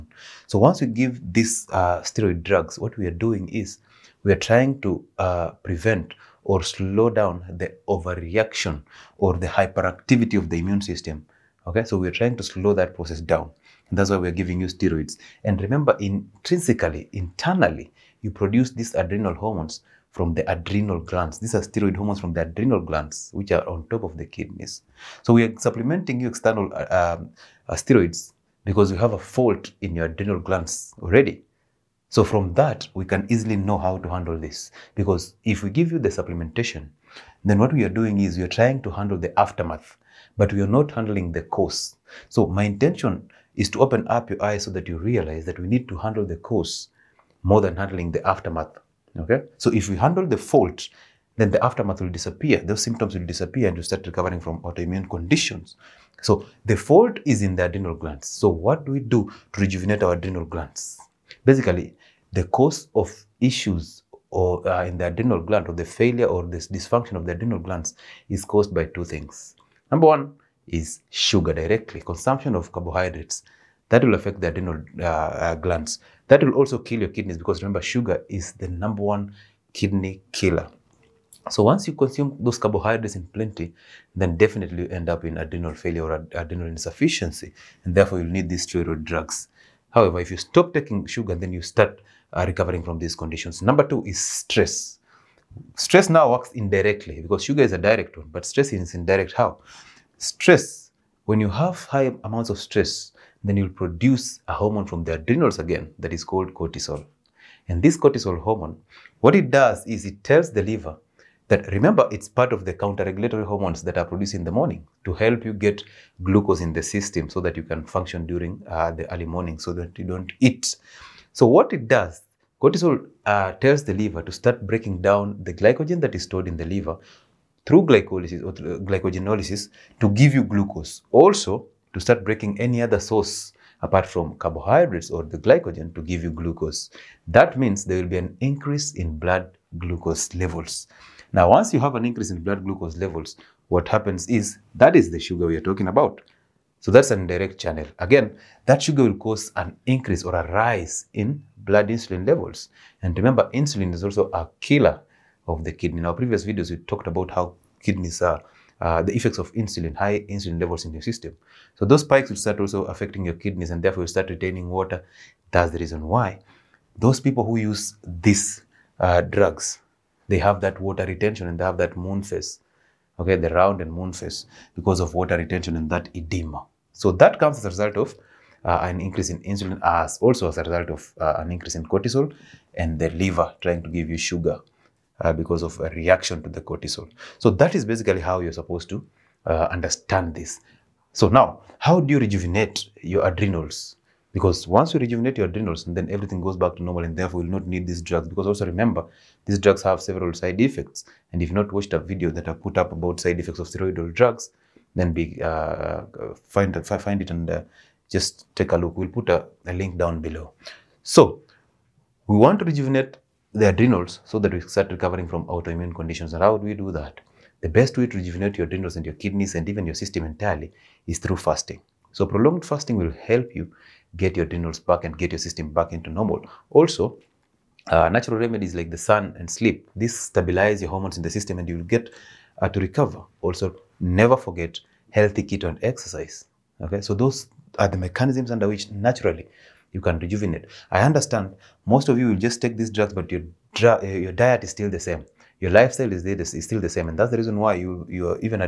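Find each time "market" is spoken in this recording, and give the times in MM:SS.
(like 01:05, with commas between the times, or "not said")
not said.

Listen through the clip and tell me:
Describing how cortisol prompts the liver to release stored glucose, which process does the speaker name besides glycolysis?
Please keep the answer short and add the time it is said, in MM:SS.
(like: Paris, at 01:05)
glycogenolysis, at 02:08.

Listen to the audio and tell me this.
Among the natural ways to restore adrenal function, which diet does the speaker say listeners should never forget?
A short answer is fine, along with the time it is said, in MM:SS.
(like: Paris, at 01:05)
healthy keto, at 03:55.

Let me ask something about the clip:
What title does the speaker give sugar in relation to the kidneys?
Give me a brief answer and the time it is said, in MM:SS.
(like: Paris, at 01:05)
number one kidney killer, at 01:18.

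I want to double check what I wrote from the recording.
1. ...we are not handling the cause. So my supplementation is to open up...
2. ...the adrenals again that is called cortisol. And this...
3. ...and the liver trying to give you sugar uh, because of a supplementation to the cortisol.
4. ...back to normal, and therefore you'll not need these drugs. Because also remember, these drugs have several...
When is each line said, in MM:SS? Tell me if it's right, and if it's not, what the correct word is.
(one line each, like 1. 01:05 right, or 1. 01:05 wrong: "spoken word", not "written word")
1. 00:40 wrong: "intention", not "supplementation"
2. 01:45 right
3. 03:02 wrong: "reaction", not "supplementation"
4. 03:16 right.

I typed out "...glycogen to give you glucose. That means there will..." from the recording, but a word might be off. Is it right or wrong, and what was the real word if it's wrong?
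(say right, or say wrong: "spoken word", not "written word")
right.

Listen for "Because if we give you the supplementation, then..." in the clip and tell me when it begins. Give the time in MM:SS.
00:34.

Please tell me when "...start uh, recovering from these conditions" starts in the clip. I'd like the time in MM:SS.
01:31.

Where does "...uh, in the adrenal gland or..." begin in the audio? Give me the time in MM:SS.
01:04.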